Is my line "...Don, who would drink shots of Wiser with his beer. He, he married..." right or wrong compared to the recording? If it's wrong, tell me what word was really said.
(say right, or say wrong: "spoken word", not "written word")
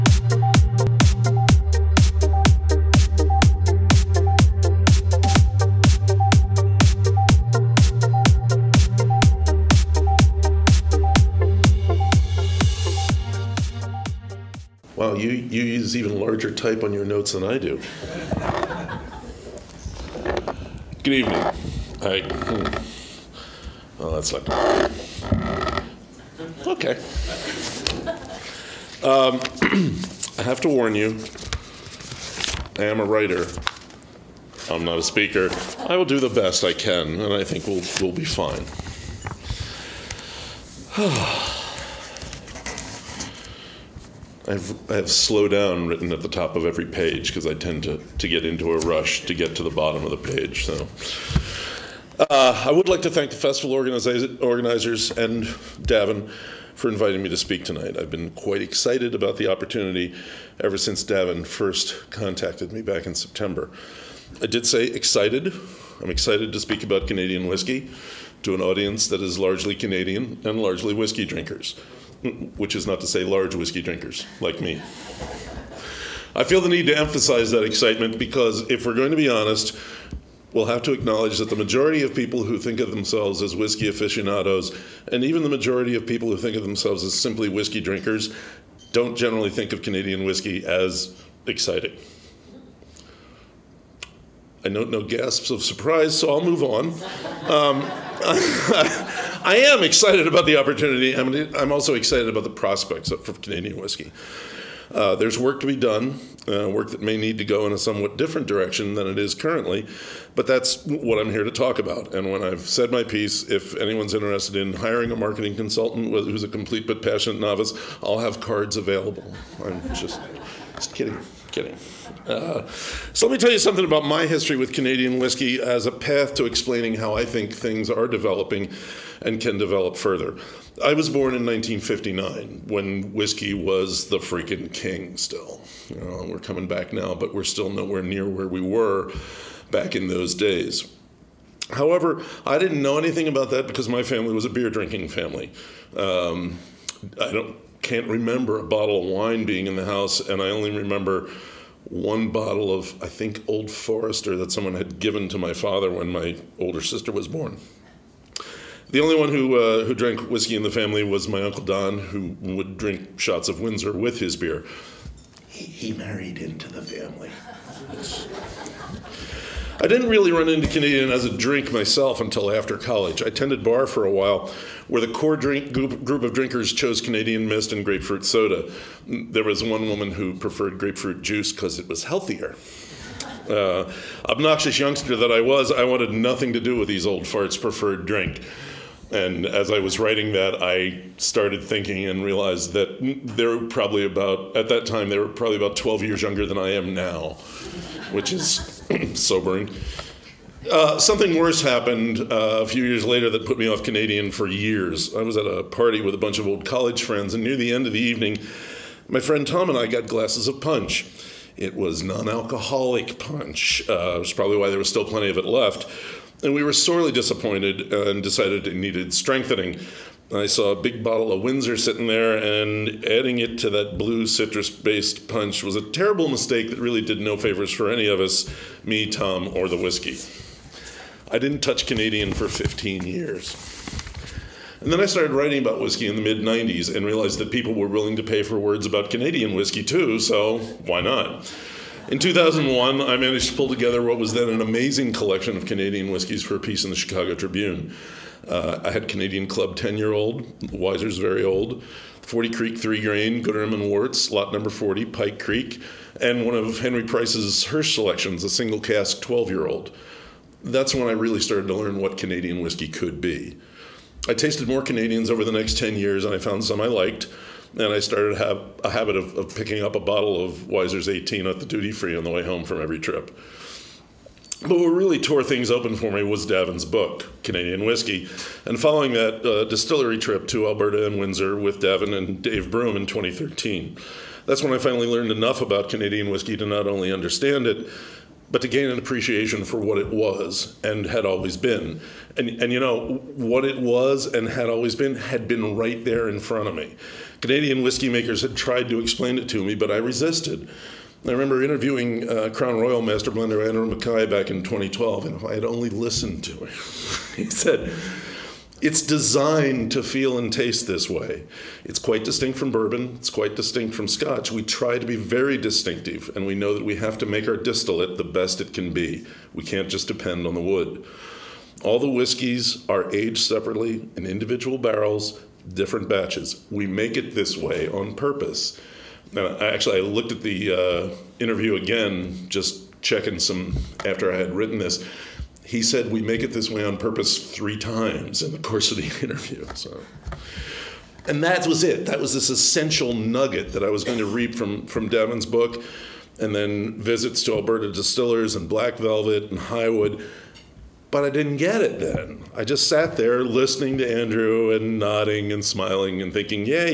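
wrong: "Windsor", not "Wiser".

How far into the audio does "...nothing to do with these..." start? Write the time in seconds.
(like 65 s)
186 s.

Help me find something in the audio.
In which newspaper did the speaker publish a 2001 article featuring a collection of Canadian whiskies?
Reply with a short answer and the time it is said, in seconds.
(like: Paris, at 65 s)
Chicago Tribune, at 246 s.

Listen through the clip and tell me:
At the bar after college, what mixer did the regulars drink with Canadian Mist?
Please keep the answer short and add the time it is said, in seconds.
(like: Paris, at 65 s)
Grapefruit soda, at 177 s.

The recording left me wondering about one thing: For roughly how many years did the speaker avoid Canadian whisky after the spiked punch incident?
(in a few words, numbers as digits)
15 years.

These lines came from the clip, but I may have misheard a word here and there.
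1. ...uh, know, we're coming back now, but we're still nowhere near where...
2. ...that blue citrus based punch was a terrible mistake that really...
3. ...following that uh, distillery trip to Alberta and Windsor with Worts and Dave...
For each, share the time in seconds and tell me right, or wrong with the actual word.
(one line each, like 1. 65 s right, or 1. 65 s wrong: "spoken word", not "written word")
1. 136 s right
2. 223 s right
3. 278 s wrong: "Davin", not "Worts".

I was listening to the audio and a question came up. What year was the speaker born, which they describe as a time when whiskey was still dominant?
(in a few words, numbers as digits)
1959.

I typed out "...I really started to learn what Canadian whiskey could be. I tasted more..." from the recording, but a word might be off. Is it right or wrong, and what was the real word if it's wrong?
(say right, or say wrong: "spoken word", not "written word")
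right.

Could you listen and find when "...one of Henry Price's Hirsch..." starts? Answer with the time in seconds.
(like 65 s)
256 s.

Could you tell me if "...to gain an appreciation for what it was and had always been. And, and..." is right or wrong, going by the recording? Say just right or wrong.
right.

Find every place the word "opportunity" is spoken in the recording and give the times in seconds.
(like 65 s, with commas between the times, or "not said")
59 s, 100 s.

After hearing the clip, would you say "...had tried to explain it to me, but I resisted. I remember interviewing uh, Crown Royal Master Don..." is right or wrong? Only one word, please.
wrong.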